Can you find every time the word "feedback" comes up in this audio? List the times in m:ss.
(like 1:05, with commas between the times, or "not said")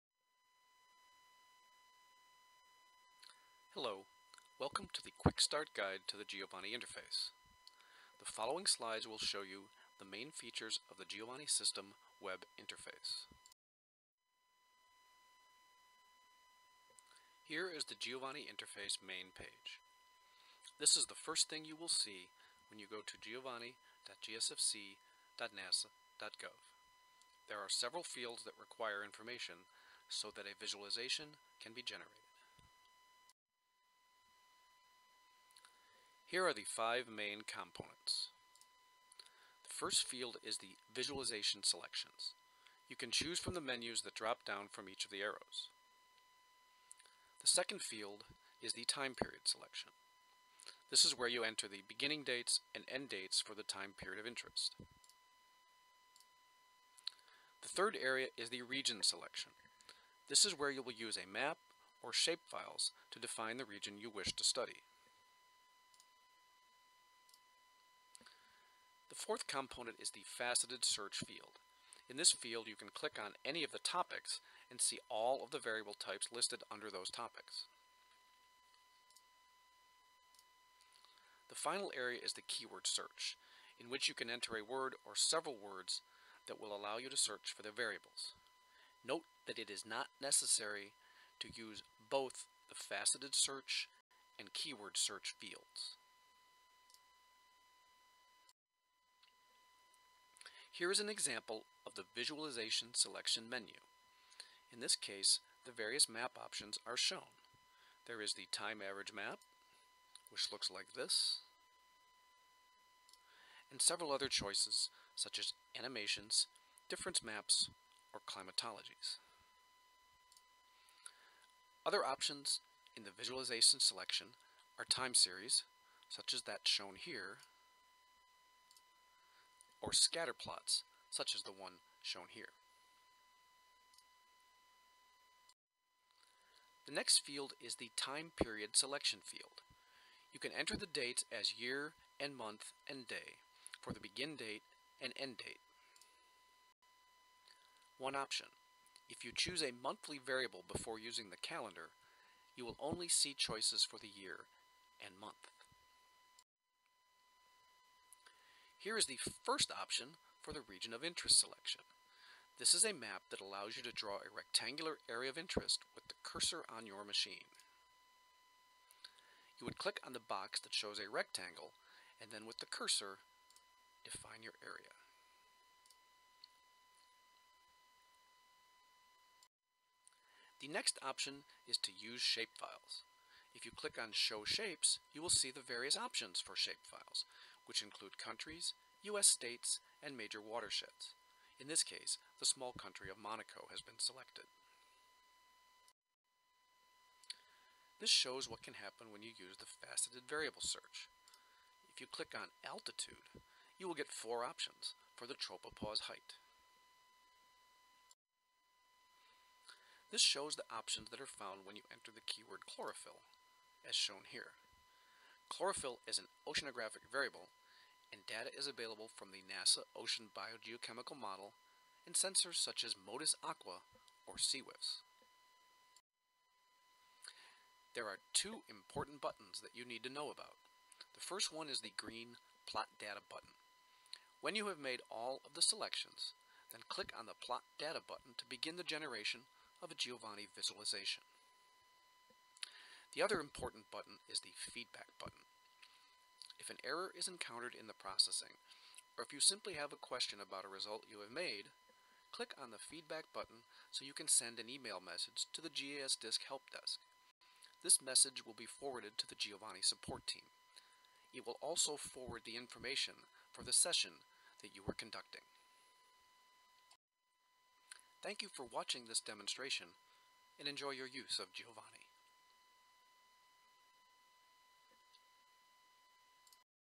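4:04, 4:12.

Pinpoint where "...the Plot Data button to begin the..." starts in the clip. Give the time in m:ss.
3:57.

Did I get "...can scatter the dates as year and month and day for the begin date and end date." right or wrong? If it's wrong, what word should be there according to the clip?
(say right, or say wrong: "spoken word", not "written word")
wrong: "enter", not "scatter".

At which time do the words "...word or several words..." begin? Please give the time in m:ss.
1:24.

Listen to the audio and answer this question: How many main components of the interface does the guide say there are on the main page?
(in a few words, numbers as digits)
5.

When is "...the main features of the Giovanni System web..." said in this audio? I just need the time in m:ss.
0:09.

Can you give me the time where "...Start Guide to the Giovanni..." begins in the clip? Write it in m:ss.
0:05.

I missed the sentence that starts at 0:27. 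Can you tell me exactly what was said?
There are several fields that require information so that a visualization can be generated.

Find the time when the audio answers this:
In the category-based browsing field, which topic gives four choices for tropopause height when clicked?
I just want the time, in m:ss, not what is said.
3:22.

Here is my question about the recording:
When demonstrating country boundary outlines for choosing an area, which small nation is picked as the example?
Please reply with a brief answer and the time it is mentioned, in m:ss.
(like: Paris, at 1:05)
Monaco, at 3:13.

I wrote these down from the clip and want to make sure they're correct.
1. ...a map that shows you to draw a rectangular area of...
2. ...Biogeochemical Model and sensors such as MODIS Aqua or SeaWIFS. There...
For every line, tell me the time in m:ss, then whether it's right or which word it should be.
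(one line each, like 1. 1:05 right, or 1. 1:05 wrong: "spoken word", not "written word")
1. 2:42 wrong: "allows", not "shows"
2. 3:40 right.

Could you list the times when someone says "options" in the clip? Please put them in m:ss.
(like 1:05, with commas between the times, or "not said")
1:46, 2:02, 2:28, 2:39, 3:01, 3:05, 3:24, 3:30.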